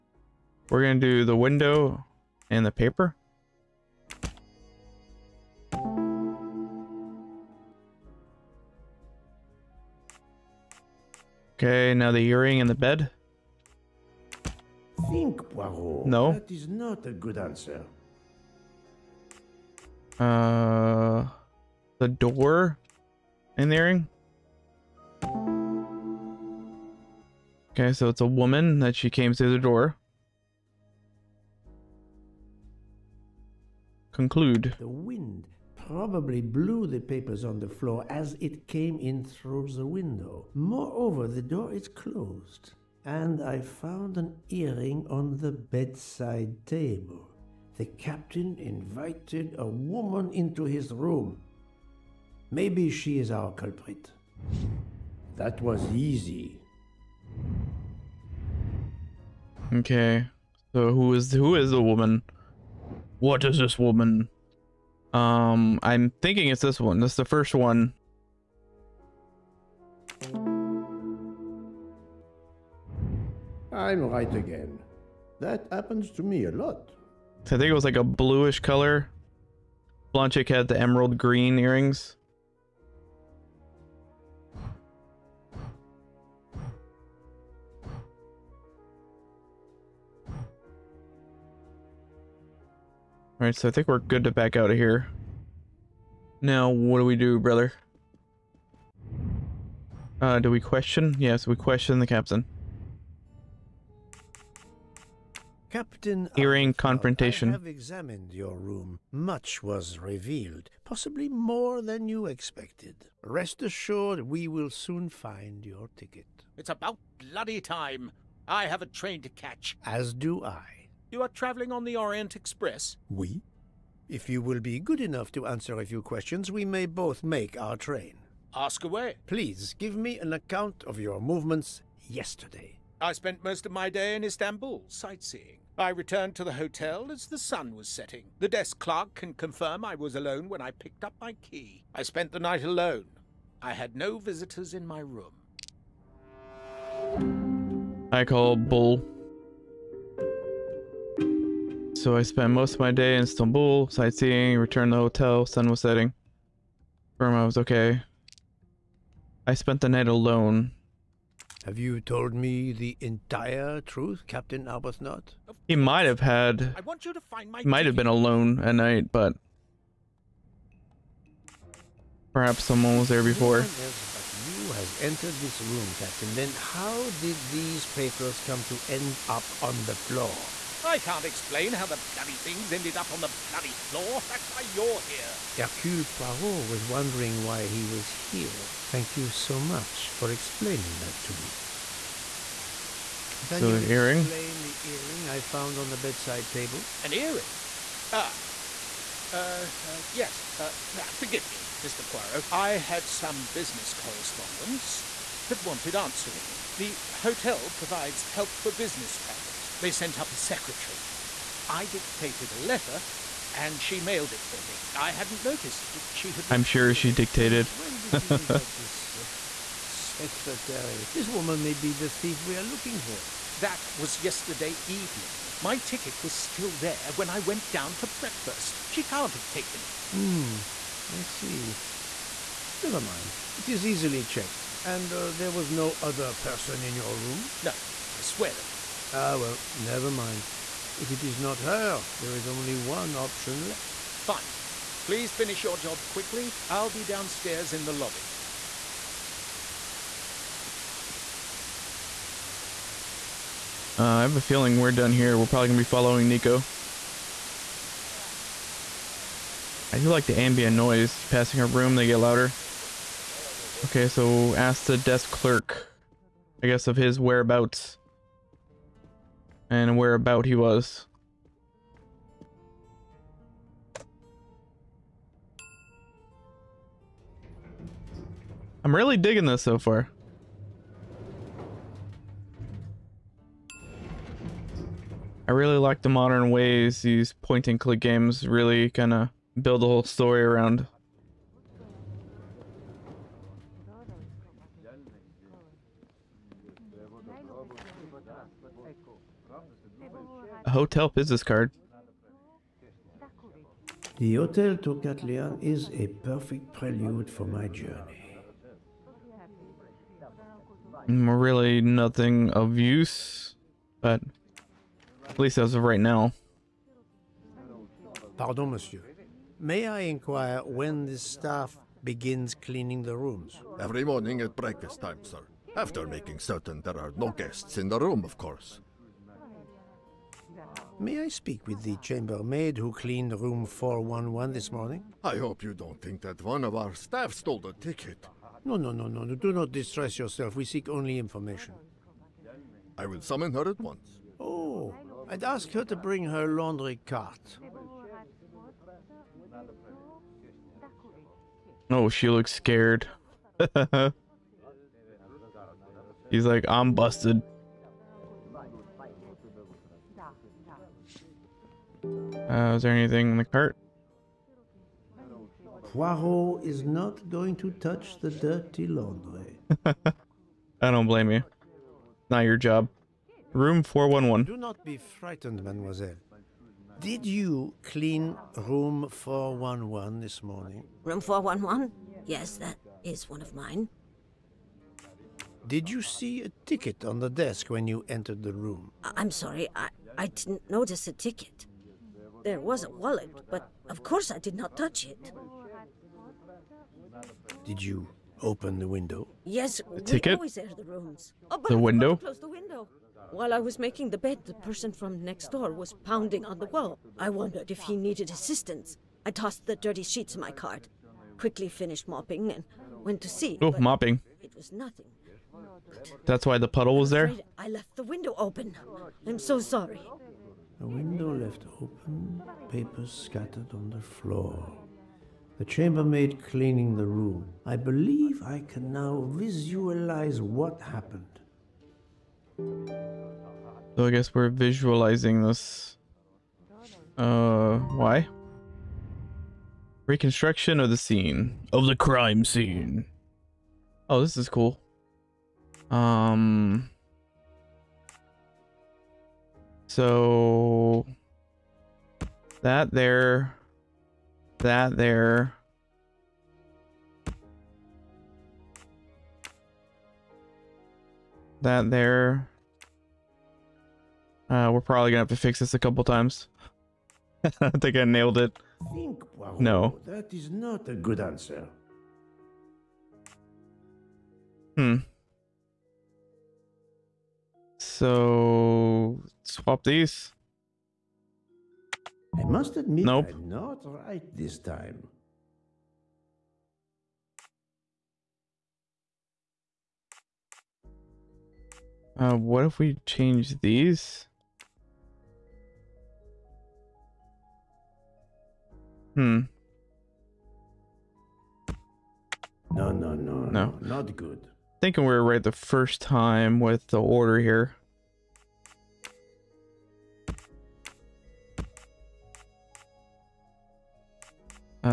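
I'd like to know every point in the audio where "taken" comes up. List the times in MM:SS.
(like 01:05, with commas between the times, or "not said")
03:49.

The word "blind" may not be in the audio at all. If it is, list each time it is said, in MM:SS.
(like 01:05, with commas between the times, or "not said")
not said.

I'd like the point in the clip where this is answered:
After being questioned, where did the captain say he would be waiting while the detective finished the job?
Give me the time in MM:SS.
04:07.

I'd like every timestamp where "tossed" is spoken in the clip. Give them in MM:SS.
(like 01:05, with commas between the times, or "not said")
06:49.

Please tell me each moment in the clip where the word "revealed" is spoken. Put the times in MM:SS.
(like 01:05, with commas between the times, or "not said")
01:49.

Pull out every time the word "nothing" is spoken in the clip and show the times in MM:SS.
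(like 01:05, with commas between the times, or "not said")
05:11, 06:54.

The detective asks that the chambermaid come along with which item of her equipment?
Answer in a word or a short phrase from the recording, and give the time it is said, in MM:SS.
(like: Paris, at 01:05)
Laundry cart, at 05:46.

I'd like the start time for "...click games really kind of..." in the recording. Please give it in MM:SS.
04:47.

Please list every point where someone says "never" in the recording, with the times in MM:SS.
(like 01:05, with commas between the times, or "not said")
03:52, 03:59.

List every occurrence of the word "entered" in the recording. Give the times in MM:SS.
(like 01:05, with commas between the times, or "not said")
02:54, 06:28.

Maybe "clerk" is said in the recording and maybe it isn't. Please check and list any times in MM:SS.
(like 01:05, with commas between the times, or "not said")
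02:18, 04:25.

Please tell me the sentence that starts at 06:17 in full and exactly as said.
Did you clean room 411 this morning?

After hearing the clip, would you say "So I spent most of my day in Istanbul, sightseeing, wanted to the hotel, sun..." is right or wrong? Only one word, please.
wrong.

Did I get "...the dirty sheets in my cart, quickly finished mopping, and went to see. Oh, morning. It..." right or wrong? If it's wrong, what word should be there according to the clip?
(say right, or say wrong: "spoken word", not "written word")
wrong: "mopping", not "morning".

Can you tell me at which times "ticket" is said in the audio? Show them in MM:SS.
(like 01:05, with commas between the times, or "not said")
01:55, 03:45, 05:37, 06:26, 06:31, 06:40.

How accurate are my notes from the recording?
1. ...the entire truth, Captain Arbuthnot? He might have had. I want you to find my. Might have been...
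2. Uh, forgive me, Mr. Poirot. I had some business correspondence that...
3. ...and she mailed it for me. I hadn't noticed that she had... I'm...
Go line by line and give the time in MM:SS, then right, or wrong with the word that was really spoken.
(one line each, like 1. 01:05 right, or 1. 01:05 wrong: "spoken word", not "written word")
1. 02:42 right
2. 03:20 right
3. 03:33 right.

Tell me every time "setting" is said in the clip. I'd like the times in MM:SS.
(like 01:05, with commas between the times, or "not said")
02:17, 02:35.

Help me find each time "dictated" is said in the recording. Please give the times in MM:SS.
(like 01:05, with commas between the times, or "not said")
03:31, 03:37.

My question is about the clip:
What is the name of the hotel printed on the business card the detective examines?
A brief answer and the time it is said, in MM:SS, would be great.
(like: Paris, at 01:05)
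Hotel Tocatlian, at 05:04.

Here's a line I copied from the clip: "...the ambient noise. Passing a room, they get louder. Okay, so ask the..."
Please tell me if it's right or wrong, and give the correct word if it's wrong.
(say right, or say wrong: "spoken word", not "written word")
right.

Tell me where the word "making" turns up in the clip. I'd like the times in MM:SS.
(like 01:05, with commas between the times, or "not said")
05:26, 06:43.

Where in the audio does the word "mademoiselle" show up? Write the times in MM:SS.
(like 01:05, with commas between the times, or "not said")
06:15.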